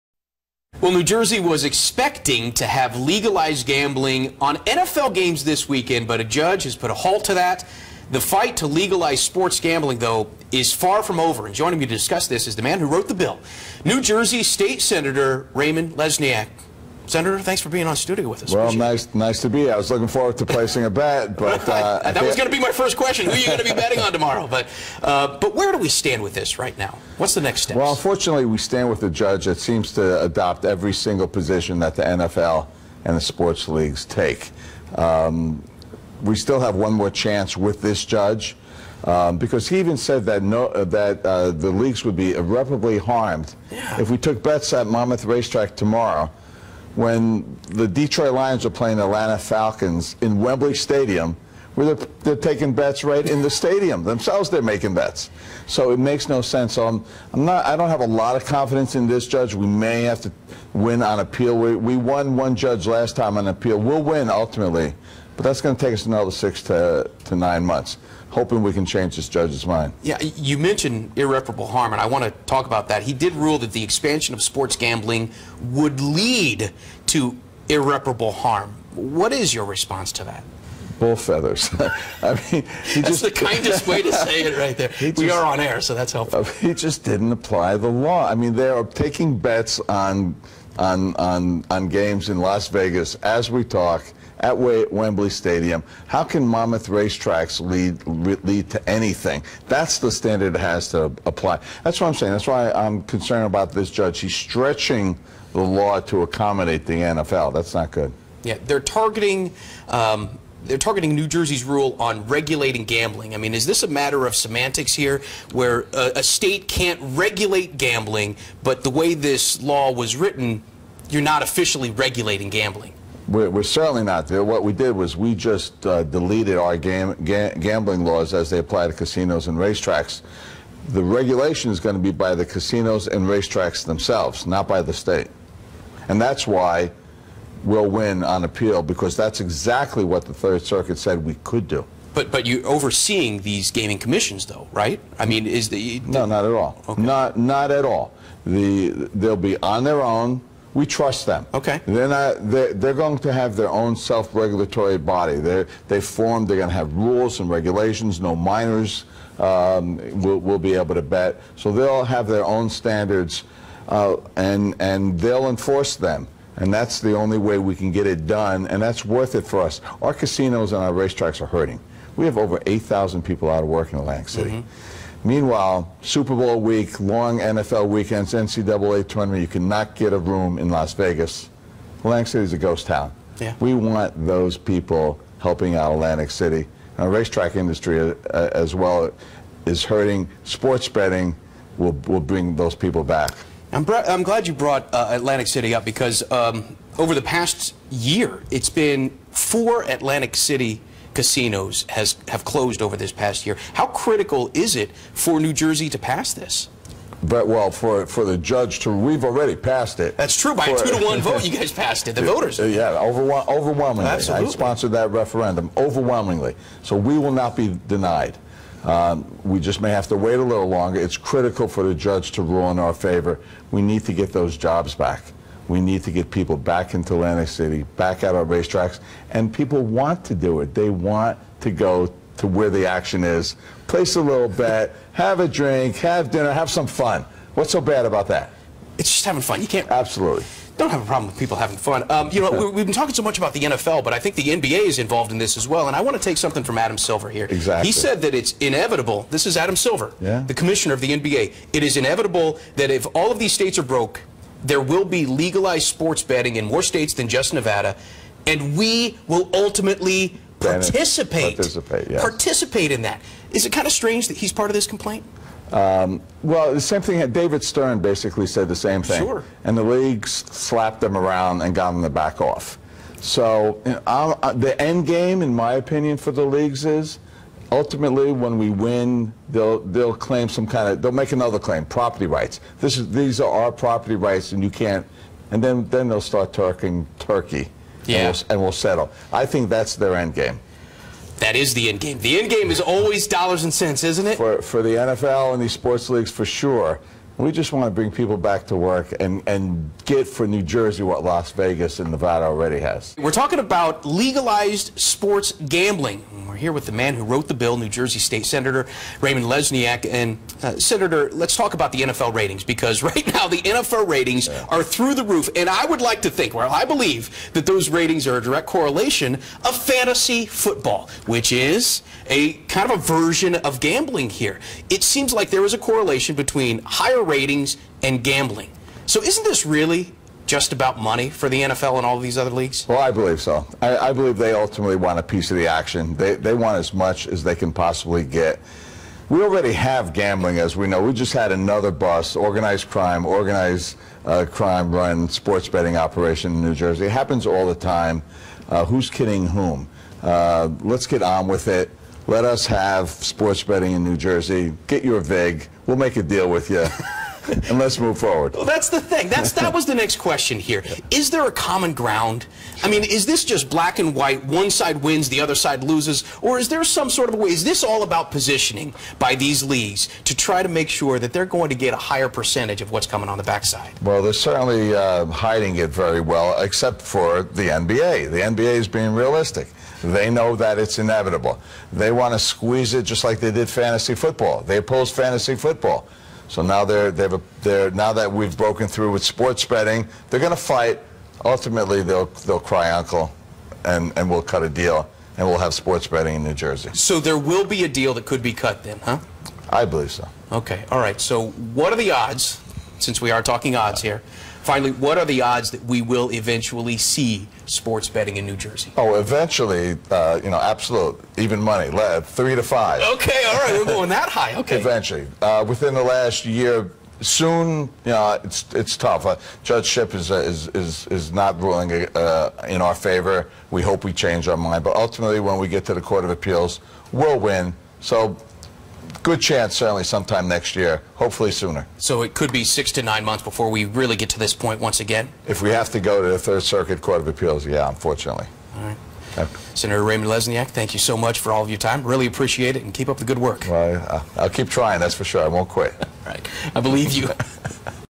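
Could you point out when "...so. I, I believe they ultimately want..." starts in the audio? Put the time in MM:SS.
05:33.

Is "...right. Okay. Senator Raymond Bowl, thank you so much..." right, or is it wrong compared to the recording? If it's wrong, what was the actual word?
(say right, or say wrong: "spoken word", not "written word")
wrong: "Lesniak", not "Bowl".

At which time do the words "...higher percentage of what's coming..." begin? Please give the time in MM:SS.
06:11.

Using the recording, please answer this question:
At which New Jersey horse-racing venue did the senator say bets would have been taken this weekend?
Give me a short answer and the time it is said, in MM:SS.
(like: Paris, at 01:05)
Monmouth Racetrack, at 00:44.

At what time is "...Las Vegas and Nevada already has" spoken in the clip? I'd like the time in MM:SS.
05:01.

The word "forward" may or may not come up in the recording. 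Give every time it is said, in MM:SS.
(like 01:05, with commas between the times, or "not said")
00:20, 05:58.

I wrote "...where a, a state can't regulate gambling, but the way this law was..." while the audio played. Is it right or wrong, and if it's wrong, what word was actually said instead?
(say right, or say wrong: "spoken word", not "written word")
right.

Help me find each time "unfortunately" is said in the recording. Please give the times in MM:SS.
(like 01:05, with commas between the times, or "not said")
00:27, 07:17.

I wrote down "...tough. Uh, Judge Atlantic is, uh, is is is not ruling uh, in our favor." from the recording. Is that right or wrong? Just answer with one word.
wrong.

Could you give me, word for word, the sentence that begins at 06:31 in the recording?
Ultimately, they'll they'll cry uncle, and and we'll cut a deal, and we'll have sports betting in New Jersey.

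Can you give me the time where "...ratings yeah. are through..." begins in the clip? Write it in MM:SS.
05:14.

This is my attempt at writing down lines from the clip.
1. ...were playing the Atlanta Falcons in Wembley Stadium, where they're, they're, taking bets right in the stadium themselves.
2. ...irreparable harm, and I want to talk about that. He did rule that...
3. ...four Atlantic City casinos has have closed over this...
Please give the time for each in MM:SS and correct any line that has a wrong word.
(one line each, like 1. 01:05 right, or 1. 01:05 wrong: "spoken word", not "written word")
1. 00:48 right
2. 01:11 right
3. 03:19 right.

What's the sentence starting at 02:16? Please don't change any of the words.
And that's why we'll win on appeal, because that's exactly what the Third Circuit said we could do.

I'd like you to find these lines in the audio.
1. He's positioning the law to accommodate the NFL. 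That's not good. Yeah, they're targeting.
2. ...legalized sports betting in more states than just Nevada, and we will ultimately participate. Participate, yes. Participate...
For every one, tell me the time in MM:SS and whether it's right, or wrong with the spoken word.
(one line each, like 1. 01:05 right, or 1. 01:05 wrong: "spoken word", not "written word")
1. 01:44 wrong: "stretching", not "positioning"
2. 04:15 right.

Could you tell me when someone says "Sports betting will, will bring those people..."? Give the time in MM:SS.
03:10.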